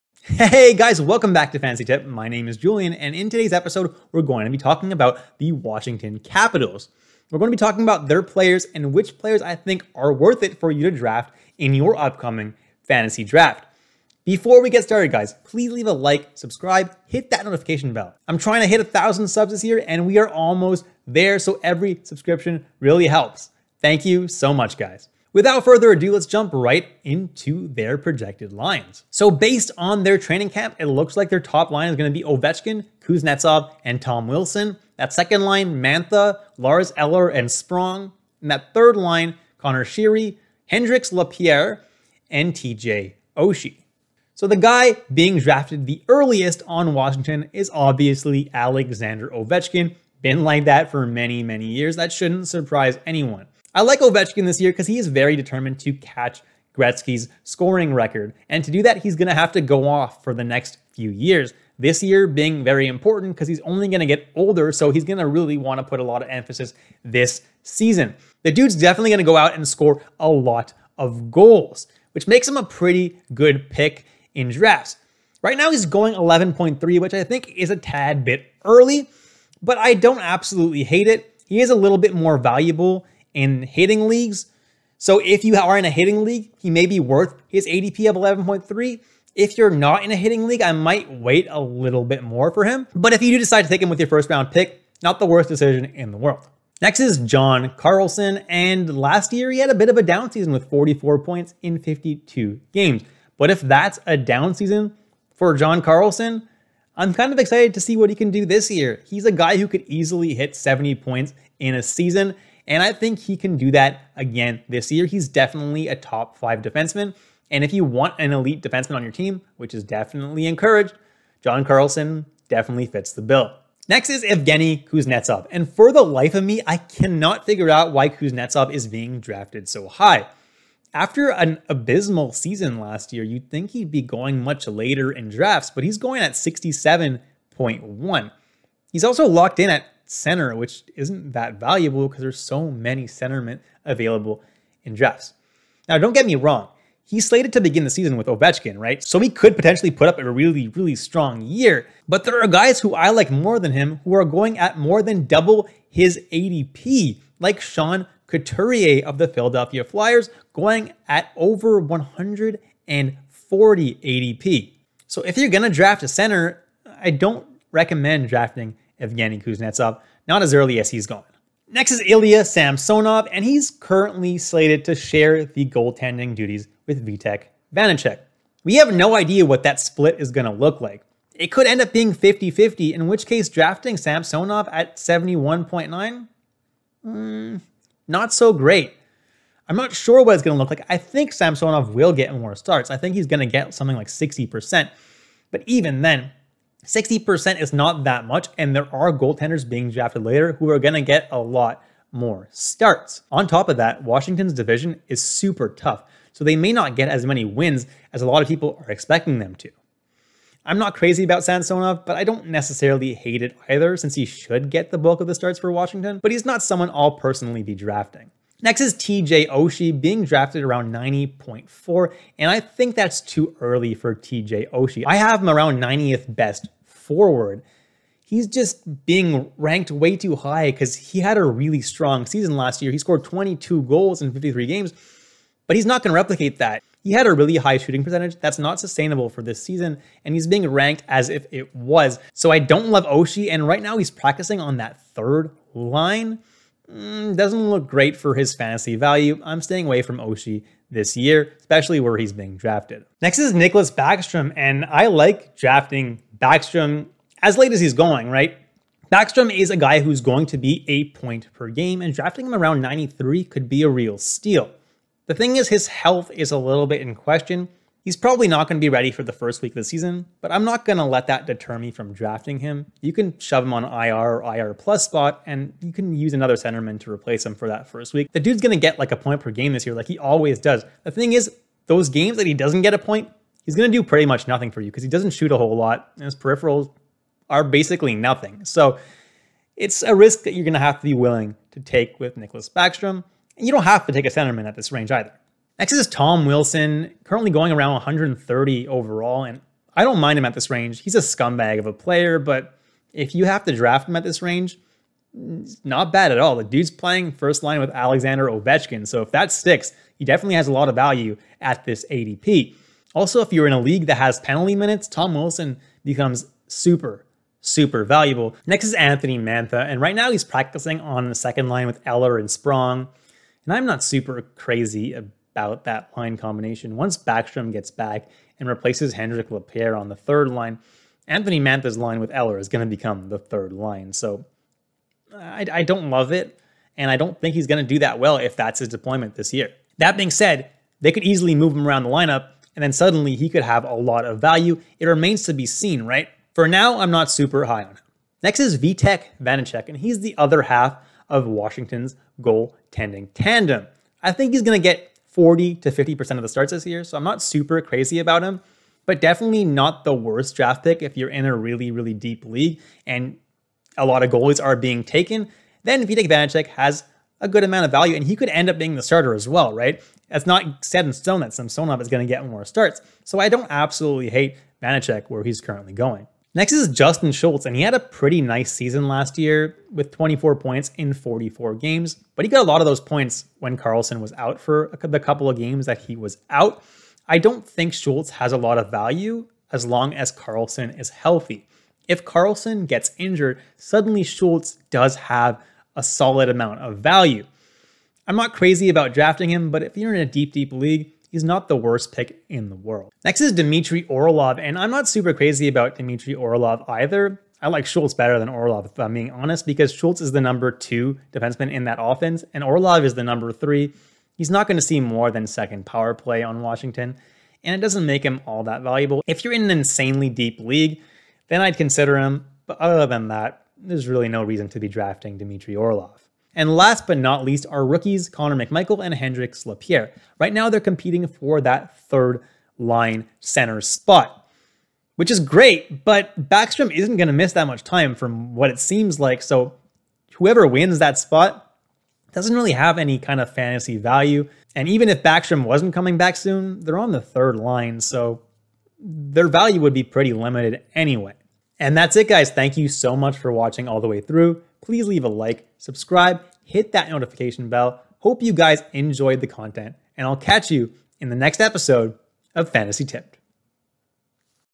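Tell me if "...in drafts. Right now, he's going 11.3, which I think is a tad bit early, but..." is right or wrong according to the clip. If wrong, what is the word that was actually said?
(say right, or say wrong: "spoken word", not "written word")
right.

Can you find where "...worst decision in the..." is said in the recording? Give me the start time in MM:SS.
01:35.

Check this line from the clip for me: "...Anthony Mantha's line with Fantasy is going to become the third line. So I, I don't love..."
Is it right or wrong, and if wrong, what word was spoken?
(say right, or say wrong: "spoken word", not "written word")
wrong: "Eller", not "Fantasy".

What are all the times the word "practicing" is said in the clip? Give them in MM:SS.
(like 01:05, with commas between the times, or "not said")
04:04, 05:20.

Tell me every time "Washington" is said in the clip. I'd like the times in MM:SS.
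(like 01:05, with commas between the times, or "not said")
00:05, 00:46, 03:24, 03:35, 05:51, 06:56.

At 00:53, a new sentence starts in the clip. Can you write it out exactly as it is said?
I like Ovechkin this year because he is very determined to catch Gretzky's scoring record.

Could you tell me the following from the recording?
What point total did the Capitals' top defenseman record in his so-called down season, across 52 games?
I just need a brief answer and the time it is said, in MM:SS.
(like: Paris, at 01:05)
44, at 01:40.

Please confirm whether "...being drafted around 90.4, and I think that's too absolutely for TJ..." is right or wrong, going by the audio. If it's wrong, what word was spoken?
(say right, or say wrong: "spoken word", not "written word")
wrong: "early", not "absolutely".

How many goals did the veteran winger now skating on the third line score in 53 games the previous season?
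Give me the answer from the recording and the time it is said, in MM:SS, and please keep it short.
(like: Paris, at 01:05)
22, at 03:53.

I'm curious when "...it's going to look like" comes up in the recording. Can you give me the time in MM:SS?
03:10.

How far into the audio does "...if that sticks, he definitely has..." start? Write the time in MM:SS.
05:09.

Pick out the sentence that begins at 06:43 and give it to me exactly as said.
Next is Dmitry Orlov, and I'm not super crazy about Dmitry Orlov either.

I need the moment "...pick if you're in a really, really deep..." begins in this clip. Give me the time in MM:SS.
06:00.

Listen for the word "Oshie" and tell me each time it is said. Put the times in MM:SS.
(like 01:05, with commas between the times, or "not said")
00:43, 03:39, 03:44, 04:03, 04:10.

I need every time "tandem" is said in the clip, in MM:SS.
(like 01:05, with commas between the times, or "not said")
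05:53.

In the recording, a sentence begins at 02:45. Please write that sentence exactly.
So if you're going to draft a center, I don't recommend drafting Evgeny Kuznetsov, not as early as he's gone.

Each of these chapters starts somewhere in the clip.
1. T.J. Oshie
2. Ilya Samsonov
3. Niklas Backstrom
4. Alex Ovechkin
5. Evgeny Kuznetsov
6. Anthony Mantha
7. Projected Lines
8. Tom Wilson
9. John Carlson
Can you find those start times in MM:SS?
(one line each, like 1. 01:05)
1. 03:38
2. 02:51
3. 04:13
4. 00:44
5. 02:03
6. 05:18
7. 00:29
8. 04:55
9. 01:36.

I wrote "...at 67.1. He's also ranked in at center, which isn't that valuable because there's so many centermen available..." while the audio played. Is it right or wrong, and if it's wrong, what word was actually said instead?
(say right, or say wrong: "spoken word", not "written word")
wrong: "locked", not "ranked".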